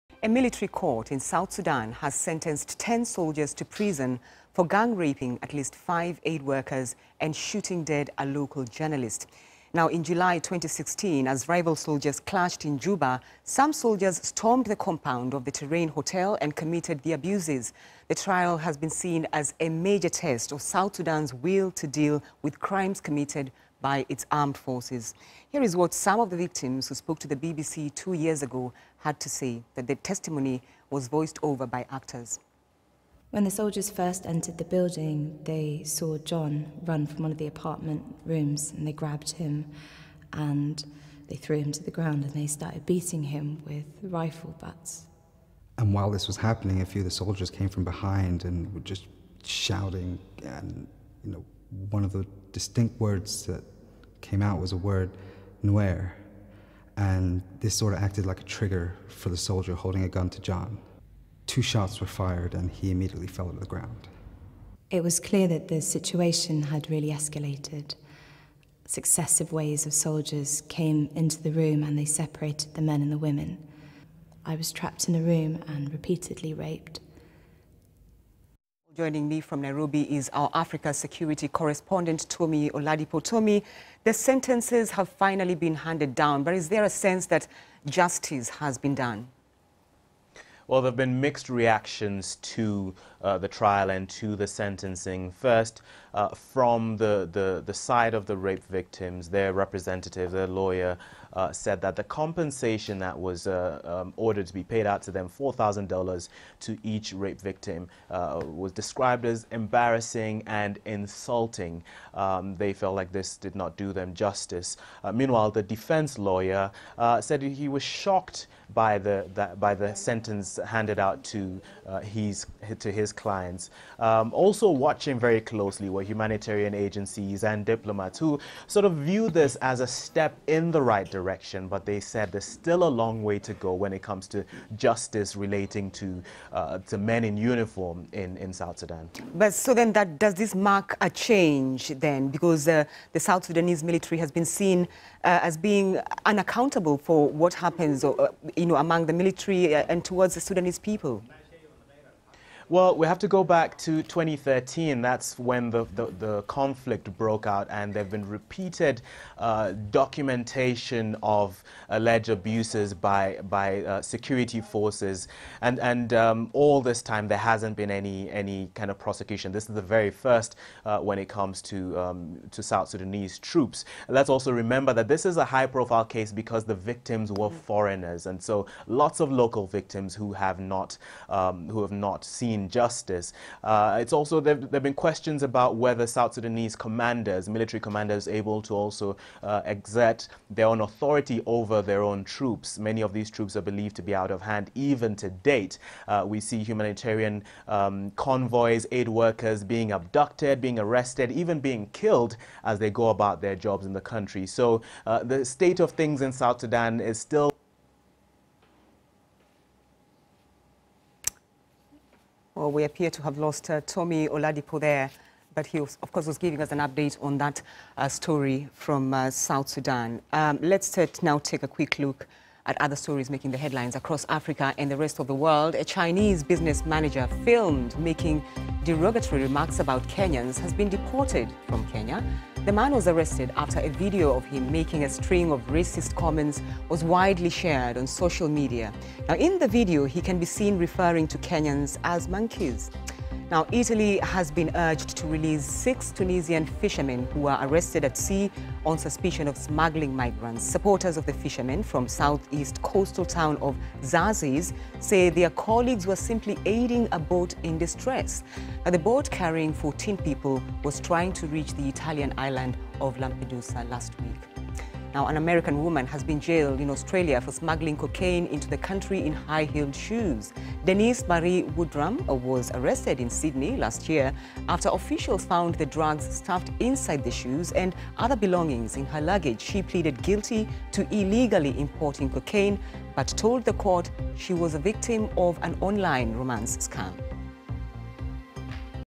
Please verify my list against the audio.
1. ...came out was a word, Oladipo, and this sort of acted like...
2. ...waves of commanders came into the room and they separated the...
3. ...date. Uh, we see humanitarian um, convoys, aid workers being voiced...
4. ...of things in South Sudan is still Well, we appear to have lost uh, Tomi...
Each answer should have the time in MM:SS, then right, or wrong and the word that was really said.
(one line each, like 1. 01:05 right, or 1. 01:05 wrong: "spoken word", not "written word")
1. 00:54 wrong: "Nuer", not "Oladipo"
2. 01:09 wrong: "soldiers", not "commanders"
3. 03:15 wrong: "abducted", not "voiced"
4. 03:25 right.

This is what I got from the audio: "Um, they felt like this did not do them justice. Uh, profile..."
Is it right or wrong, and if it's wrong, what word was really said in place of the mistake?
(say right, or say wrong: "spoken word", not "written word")
wrong: "meanwhile", not "profile".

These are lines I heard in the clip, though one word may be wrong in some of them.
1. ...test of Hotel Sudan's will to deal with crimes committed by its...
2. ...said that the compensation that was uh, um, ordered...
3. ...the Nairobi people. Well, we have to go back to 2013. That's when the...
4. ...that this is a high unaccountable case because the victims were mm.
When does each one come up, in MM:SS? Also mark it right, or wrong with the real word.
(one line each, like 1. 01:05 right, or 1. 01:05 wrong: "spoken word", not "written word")
1. 00:20 wrong: "South", not "Hotel"
2. 01:41 right
3. 02:30 wrong: "Sudanese", not "Nairobi"
4. 02:54 wrong: "profile", not "unaccountable".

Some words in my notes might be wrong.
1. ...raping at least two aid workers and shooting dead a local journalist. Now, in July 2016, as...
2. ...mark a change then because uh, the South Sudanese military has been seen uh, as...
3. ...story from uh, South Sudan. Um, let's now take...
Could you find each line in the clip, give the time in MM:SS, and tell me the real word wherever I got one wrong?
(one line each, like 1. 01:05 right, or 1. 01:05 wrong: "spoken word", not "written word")
1. 00:04 wrong: "five", not "two"
2. 02:20 right
3. 03:38 right.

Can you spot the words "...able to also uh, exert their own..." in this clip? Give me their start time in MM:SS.
03:08.